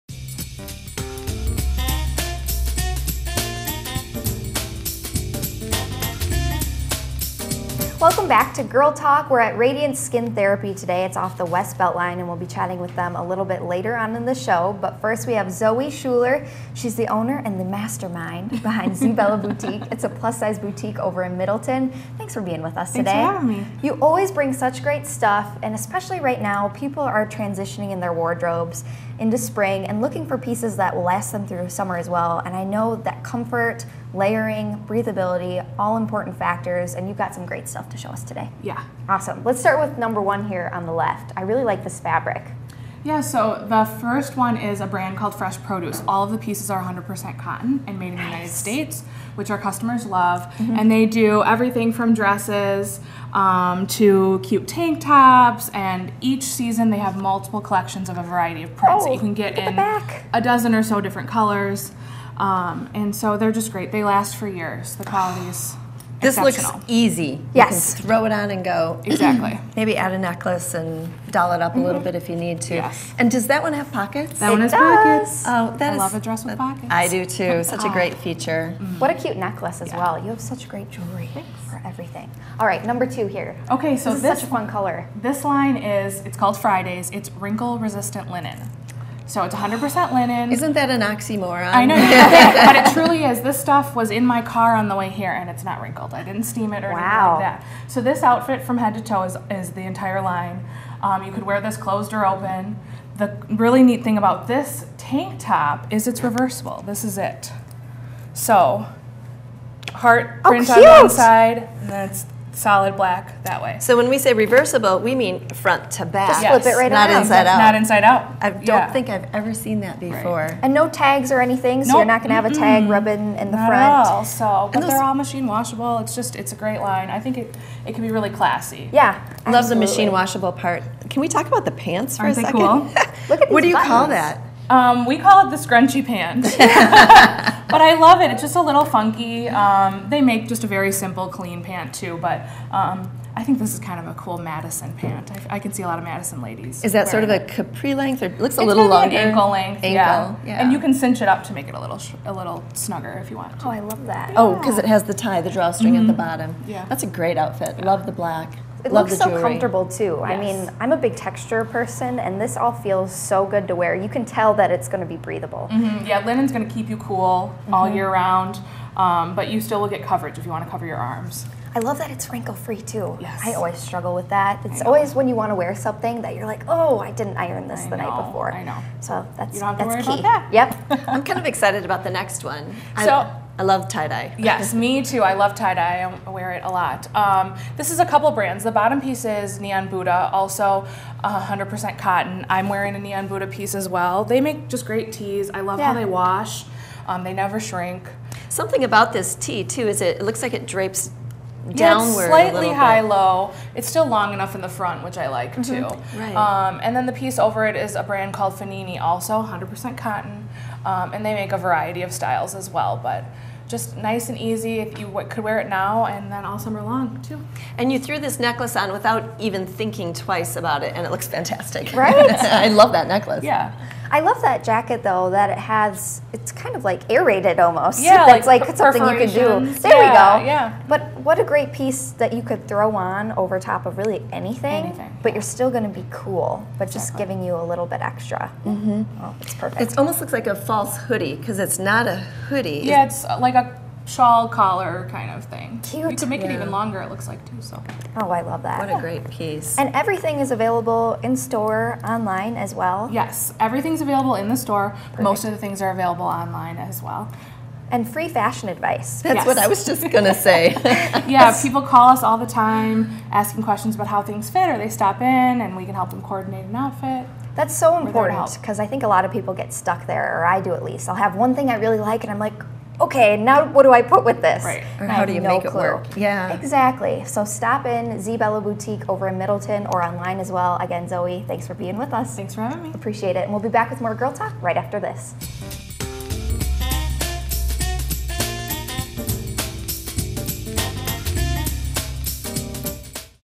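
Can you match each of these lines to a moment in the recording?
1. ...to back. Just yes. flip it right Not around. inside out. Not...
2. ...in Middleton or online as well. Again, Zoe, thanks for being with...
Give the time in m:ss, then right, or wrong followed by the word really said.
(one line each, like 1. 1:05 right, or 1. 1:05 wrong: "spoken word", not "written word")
1. 1:55 right
2. 4:39 right.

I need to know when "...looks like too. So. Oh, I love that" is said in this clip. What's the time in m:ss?
4:07.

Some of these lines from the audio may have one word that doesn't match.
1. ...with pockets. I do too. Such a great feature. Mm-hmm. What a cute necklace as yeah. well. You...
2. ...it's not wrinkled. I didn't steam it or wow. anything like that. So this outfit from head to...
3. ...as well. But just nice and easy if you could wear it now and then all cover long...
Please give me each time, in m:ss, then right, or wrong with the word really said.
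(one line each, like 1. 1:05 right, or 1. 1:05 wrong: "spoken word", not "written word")
1. 1:16 right
2. 1:35 right
3. 3:32 wrong: "summer", not "cover".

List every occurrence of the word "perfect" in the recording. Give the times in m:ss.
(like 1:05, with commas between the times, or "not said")
3:59, 4:14.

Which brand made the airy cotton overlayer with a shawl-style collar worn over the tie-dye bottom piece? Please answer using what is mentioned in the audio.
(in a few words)
Fenini.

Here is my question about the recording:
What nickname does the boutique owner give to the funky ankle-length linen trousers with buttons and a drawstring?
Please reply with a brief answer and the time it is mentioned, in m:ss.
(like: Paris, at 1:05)
the scrunchy pants, at 2:15.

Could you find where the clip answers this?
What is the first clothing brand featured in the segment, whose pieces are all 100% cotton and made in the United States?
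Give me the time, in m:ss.
0:45.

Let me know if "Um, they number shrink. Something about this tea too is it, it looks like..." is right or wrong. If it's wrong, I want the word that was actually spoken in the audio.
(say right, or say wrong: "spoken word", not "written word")
wrong: "never", not "number".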